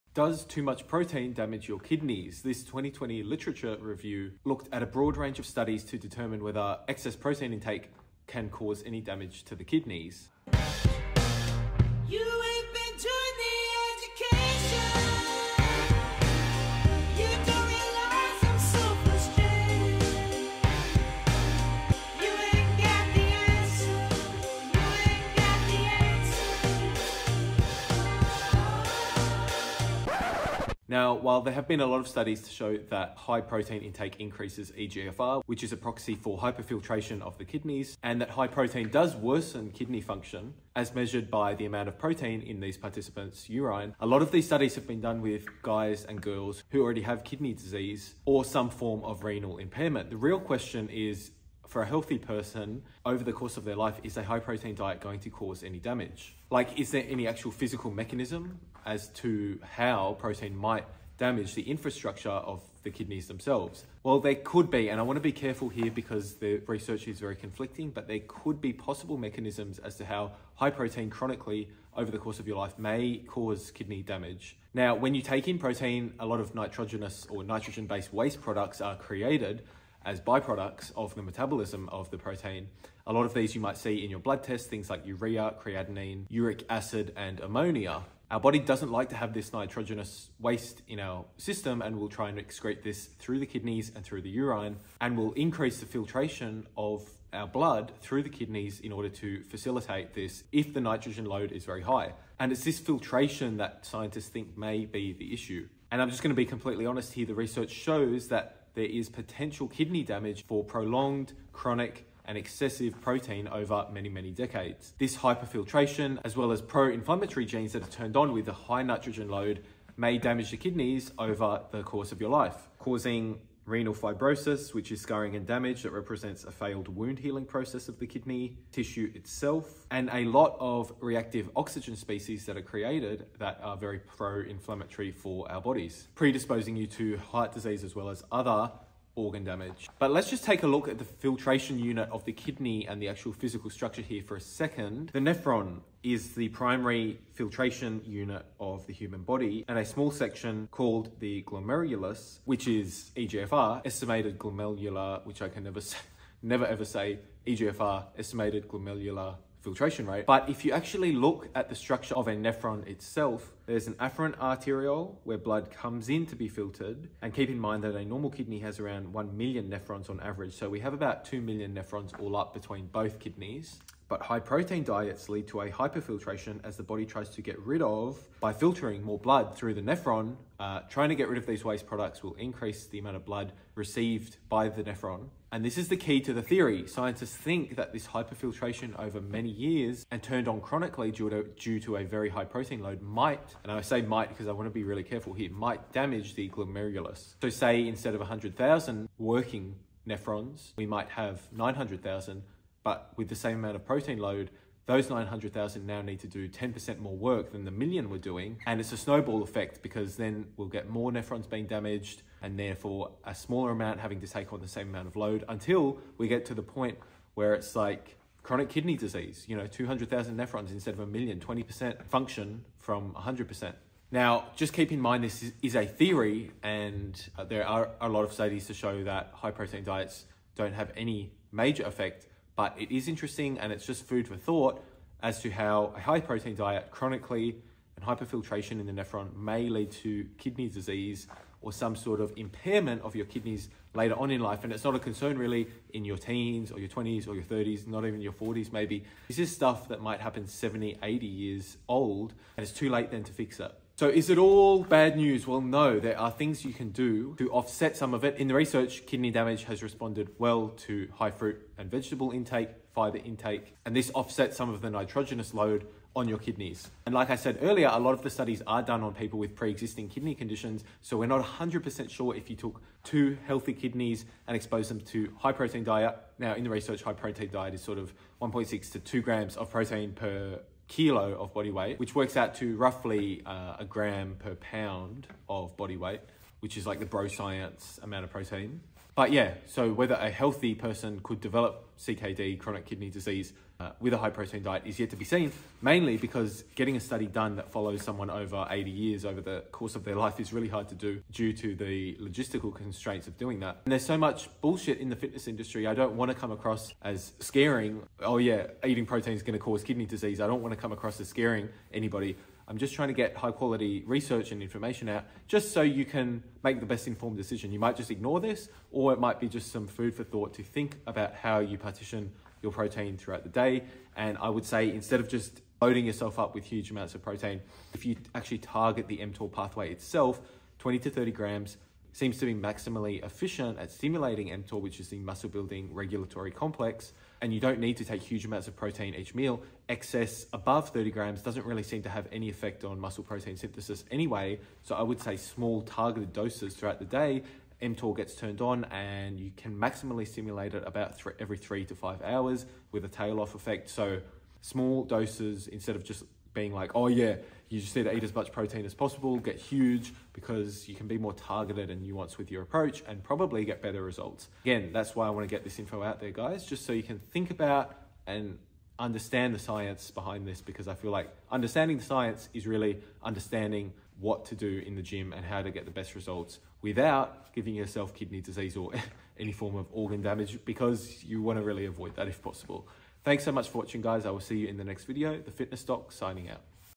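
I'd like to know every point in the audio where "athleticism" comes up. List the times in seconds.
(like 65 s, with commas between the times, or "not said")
not said.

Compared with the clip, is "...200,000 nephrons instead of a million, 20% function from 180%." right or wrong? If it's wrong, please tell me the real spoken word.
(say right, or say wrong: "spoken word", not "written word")
wrong: "100", not "180".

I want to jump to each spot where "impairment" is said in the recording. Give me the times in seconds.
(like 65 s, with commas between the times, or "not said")
49 s, 242 s.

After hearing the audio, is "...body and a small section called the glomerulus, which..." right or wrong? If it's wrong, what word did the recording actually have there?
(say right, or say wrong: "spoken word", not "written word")
right.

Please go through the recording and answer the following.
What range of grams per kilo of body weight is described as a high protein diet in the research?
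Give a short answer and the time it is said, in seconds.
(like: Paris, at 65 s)
1.6 to 2 grams, at 278 s.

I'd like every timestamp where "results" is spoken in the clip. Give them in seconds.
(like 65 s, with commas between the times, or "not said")
364 s, 376 s.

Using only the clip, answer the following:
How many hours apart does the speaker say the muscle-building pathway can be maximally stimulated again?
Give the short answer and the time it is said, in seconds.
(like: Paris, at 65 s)
3 to 5 hours, at 351 s.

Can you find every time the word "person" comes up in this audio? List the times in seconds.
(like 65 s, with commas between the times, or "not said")
52 s, 290 s.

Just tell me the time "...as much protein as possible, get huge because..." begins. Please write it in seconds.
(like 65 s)
358 s.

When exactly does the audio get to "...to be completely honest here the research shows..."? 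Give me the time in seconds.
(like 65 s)
106 s.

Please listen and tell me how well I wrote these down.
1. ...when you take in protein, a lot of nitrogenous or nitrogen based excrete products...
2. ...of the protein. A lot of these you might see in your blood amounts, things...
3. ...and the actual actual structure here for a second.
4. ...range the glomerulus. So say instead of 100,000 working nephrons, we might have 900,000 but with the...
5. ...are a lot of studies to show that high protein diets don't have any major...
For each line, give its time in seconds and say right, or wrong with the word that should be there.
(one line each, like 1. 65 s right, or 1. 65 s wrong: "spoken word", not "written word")
1. 74 s wrong: "waste", not "excrete"
2. 81 s wrong: "tests", not "amounts"
3. 142 s wrong: "physical", not "actual"
4. 195 s wrong: "damage", not "range"
5. 227 s right.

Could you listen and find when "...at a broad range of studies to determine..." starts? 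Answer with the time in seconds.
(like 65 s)
4 s.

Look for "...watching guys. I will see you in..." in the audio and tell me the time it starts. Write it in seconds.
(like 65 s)
383 s.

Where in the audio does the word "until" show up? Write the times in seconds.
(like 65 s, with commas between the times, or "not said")
215 s.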